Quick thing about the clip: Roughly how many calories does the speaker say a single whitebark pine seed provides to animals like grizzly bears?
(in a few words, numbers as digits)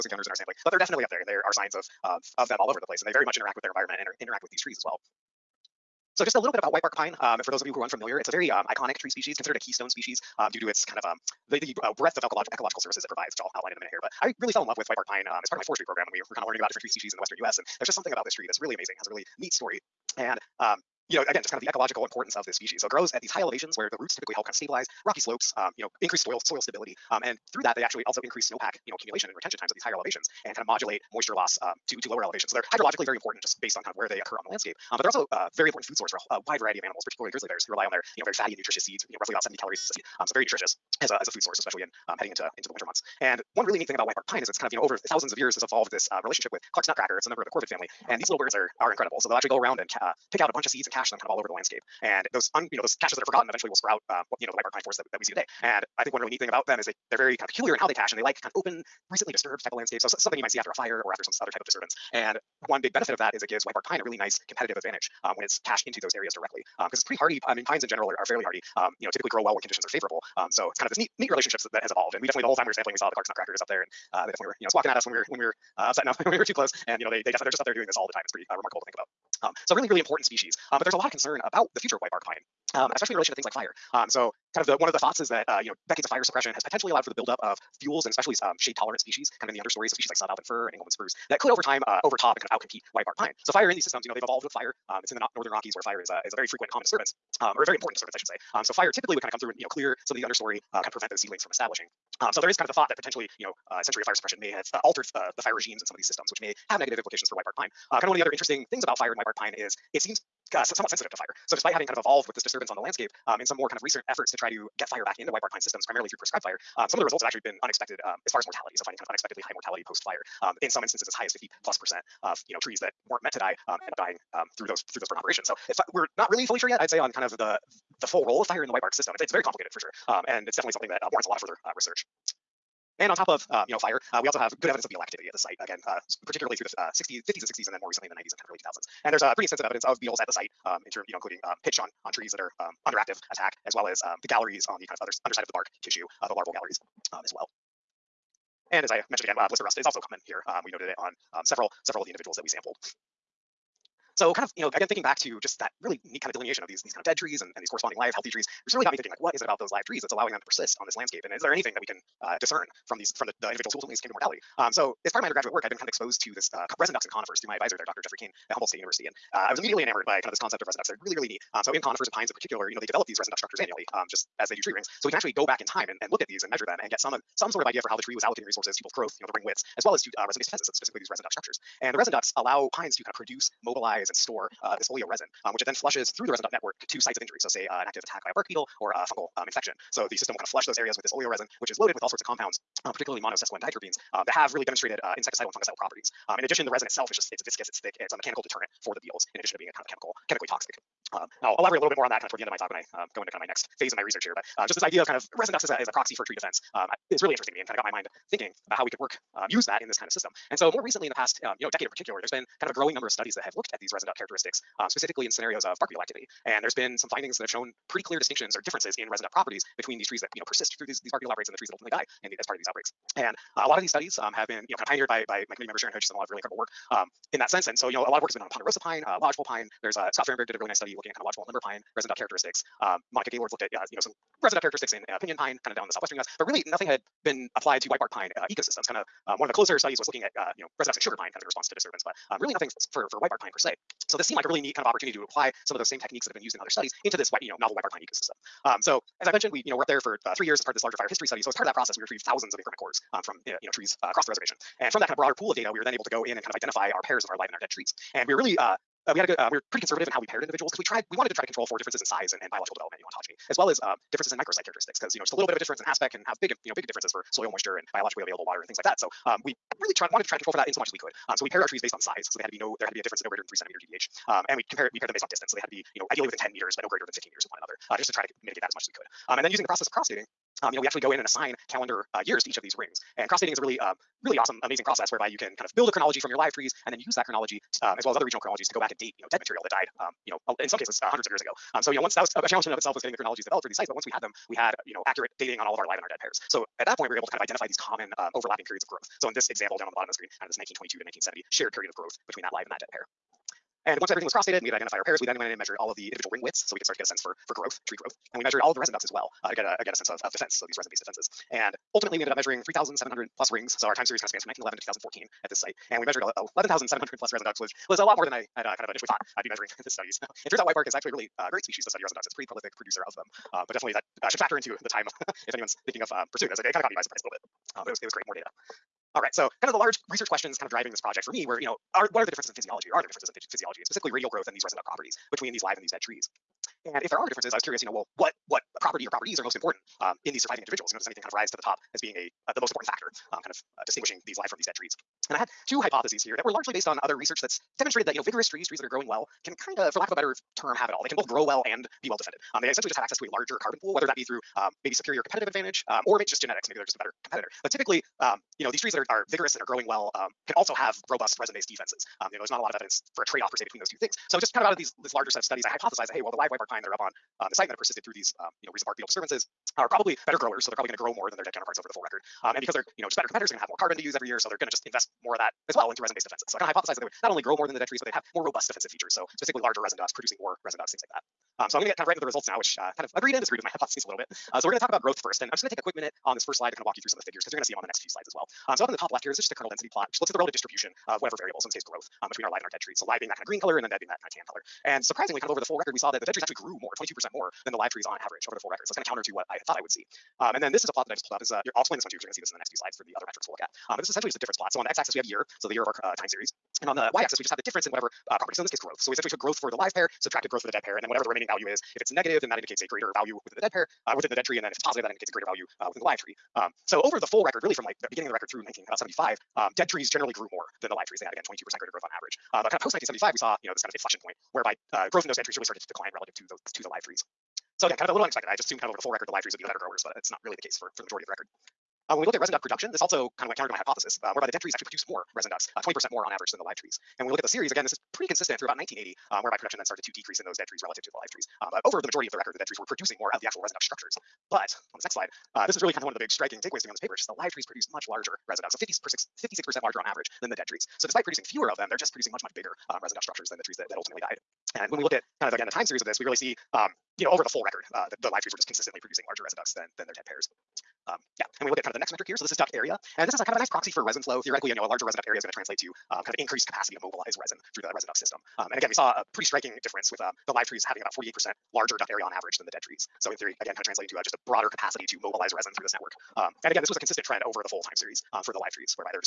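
70 calories.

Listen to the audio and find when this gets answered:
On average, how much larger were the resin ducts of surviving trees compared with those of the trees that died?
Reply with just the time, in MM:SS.
07:28.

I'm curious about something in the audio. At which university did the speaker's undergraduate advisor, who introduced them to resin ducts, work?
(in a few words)
Humboldt State University.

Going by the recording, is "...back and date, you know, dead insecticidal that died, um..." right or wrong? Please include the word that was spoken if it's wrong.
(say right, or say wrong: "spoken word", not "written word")
wrong: "material", not "insecticidal".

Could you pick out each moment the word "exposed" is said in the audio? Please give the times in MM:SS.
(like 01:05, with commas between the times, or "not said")
02:45.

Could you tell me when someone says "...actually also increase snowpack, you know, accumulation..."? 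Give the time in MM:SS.
00:27.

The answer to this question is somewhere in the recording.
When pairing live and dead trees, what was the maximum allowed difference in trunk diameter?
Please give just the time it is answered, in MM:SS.
04:33.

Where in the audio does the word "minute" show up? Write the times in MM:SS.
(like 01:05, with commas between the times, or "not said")
00:13, 06:25.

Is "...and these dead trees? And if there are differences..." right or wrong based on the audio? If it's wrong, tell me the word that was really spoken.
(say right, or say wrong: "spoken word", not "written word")
right.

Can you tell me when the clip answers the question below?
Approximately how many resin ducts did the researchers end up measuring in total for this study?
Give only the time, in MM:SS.
05:16.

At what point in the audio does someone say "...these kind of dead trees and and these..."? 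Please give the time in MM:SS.
02:36.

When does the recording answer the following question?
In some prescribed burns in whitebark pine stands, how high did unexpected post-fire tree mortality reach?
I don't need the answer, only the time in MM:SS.
02:01.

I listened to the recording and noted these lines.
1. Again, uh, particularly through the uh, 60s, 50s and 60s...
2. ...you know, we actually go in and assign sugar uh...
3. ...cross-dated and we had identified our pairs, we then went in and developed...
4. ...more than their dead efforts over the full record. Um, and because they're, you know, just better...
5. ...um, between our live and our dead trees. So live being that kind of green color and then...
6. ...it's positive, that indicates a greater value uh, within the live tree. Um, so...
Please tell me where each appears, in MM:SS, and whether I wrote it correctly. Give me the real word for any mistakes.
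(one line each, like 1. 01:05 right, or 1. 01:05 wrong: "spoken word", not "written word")
1. 02:15 right
2. 04:40 wrong: "calendar", not "sugar"
3. 05:04 wrong: "measured", not "developed"
4. 06:11 wrong: "counterparts", not "efforts"
5. 06:32 right
6. 06:54 right.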